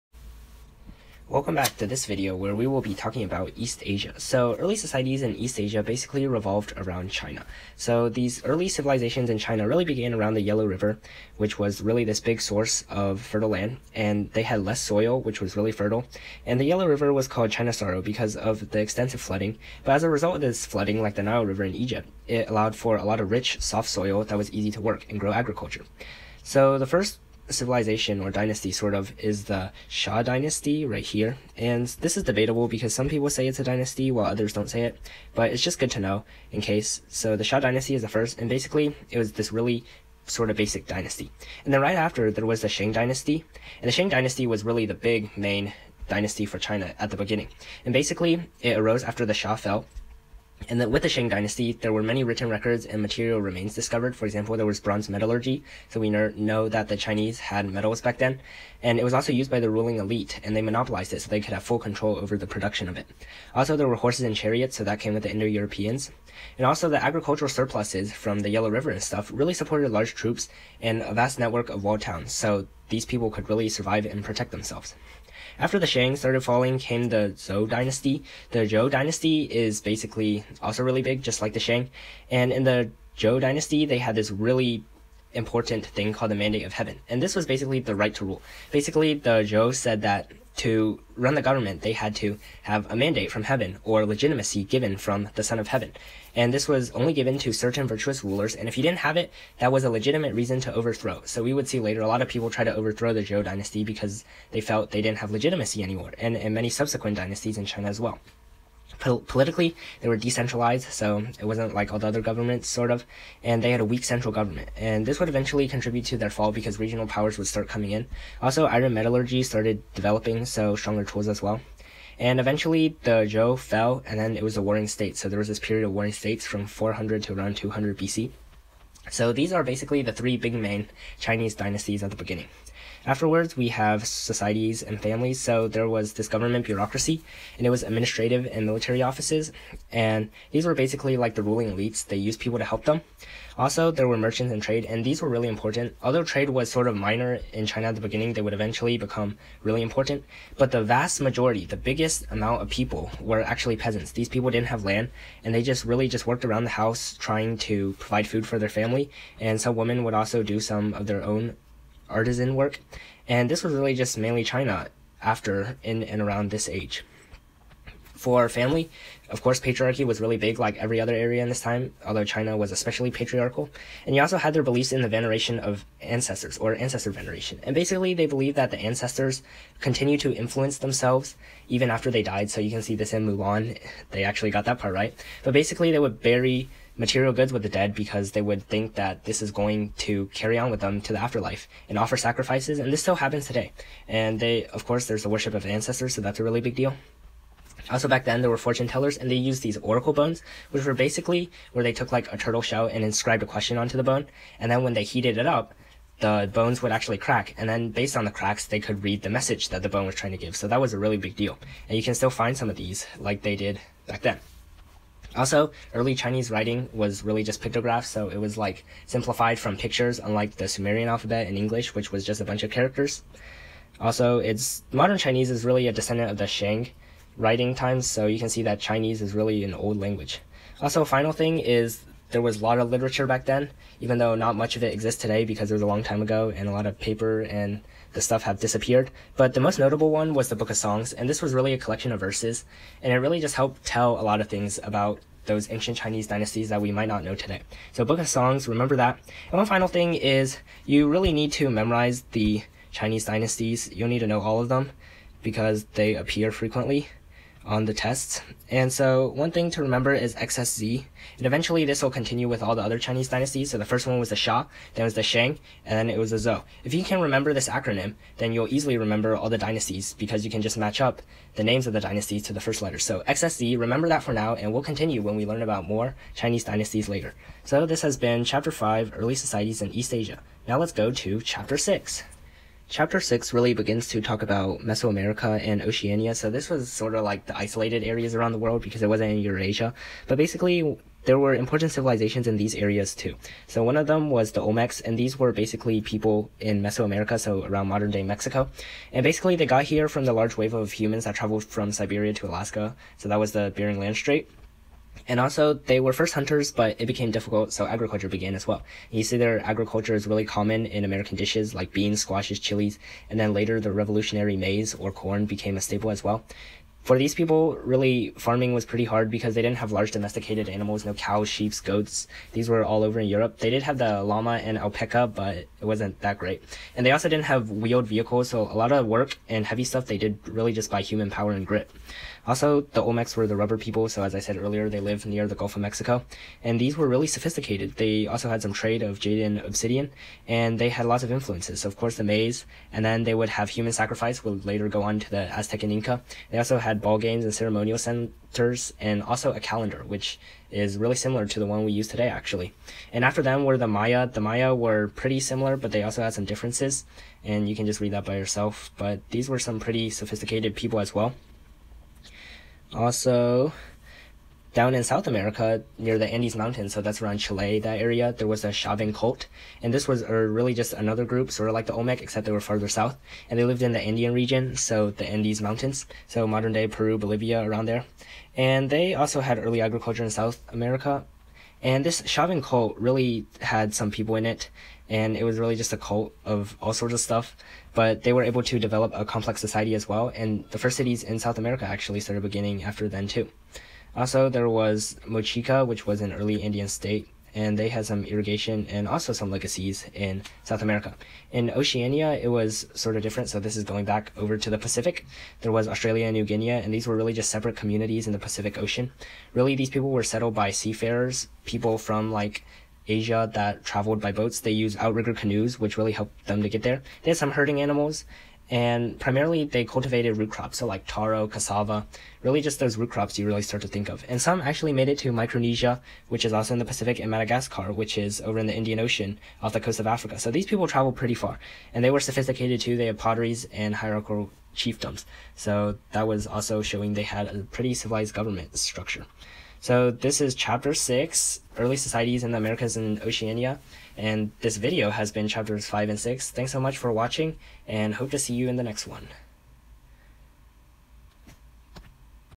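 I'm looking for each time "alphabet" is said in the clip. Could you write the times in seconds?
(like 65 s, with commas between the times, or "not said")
221 s.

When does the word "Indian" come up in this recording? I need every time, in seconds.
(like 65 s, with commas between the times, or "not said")
396 s, 428 s.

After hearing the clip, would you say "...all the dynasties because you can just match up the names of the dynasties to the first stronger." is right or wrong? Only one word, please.
wrong.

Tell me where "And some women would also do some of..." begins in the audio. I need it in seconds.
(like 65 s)
159 s.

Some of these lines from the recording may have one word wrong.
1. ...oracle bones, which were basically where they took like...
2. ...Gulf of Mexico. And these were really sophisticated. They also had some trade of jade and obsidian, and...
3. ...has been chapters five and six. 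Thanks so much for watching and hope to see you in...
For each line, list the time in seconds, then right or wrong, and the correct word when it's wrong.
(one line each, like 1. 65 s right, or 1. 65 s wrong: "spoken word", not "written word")
1. 199 s right
2. 335 s right
3. 445 s right.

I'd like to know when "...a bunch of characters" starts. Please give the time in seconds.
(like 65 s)
222 s.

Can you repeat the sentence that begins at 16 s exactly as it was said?
And the Yellow River was called China Sorrow because of the extensive flooding.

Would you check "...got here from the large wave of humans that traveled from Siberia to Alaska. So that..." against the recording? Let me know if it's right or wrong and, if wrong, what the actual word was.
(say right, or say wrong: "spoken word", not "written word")
right.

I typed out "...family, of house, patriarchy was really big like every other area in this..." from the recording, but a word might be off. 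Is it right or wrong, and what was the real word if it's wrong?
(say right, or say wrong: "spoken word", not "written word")
wrong: "course", not "house".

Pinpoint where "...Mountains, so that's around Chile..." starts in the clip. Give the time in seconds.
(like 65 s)
366 s.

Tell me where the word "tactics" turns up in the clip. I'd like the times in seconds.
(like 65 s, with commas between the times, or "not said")
not said.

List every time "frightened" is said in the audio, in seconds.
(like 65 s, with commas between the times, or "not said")
not said.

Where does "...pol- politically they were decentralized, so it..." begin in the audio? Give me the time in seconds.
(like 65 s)
109 s.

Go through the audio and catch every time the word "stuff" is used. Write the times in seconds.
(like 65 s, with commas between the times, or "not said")
69 s, 238 s, 329 s, 387 s.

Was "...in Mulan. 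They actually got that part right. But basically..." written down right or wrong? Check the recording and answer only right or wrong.
right.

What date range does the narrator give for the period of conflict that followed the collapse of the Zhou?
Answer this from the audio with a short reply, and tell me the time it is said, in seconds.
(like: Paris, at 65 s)
400 to 200 BC, at 126 s.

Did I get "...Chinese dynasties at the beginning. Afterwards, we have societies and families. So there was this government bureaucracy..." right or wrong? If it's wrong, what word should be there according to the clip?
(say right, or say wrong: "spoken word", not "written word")
right.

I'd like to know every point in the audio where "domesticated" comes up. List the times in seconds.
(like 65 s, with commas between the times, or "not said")
320 s.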